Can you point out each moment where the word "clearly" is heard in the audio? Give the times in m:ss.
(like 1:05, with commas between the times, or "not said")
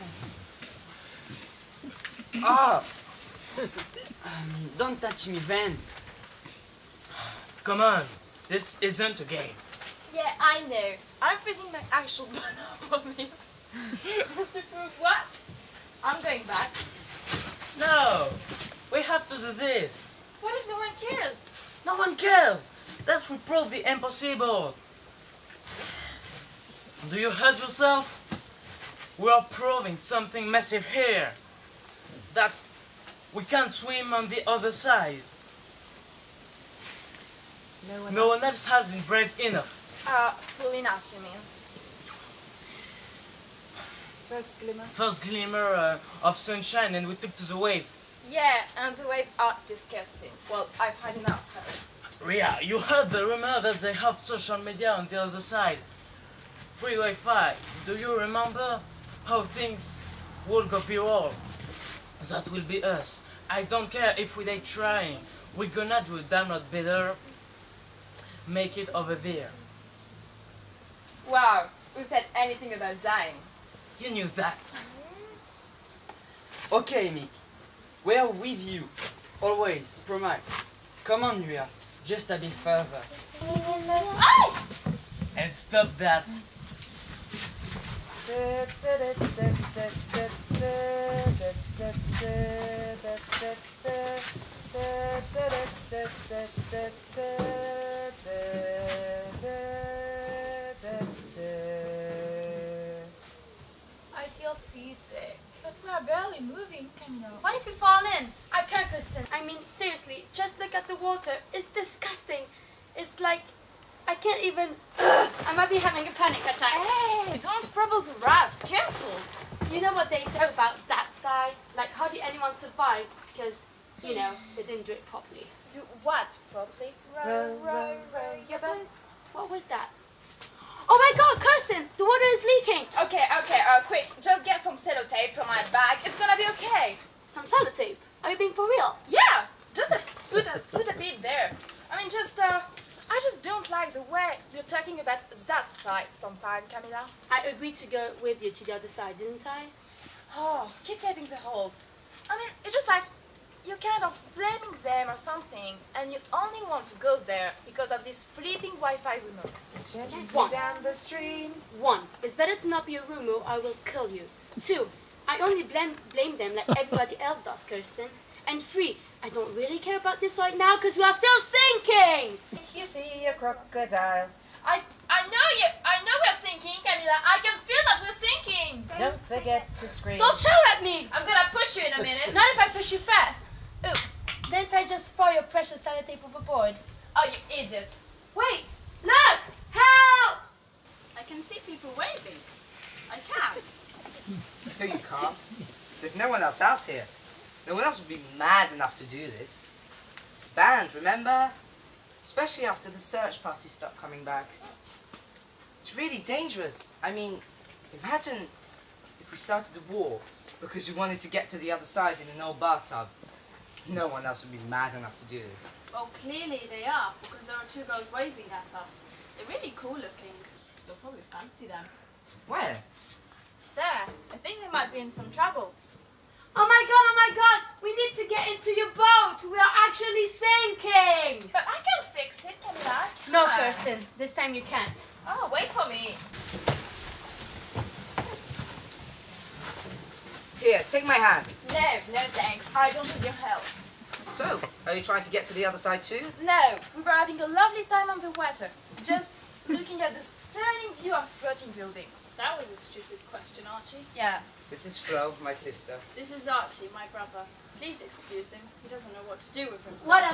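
3:36.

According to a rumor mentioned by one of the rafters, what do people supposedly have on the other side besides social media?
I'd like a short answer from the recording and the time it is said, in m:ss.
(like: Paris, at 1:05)
Free Wi-Fi, at 0:56.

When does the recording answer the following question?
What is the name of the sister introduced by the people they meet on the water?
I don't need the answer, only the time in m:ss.
4:14.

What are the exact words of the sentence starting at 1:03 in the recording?
I don't care if we they trying.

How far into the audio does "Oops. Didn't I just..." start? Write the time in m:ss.
3:03.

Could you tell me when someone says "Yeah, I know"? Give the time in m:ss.
0:10.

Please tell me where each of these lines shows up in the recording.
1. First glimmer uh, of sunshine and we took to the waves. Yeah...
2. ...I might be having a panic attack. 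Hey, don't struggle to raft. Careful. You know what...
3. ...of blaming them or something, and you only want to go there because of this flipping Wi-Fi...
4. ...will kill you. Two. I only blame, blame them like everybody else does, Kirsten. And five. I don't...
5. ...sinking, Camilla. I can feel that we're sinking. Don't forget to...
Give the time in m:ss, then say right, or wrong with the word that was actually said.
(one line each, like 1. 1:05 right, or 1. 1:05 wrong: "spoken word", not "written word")
1. 0:44 right
2. 1:55 right
3. 2:34 right
4. 2:43 wrong: "three", not "five"
5. 2:56 right.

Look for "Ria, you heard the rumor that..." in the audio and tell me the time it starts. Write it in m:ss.
0:52.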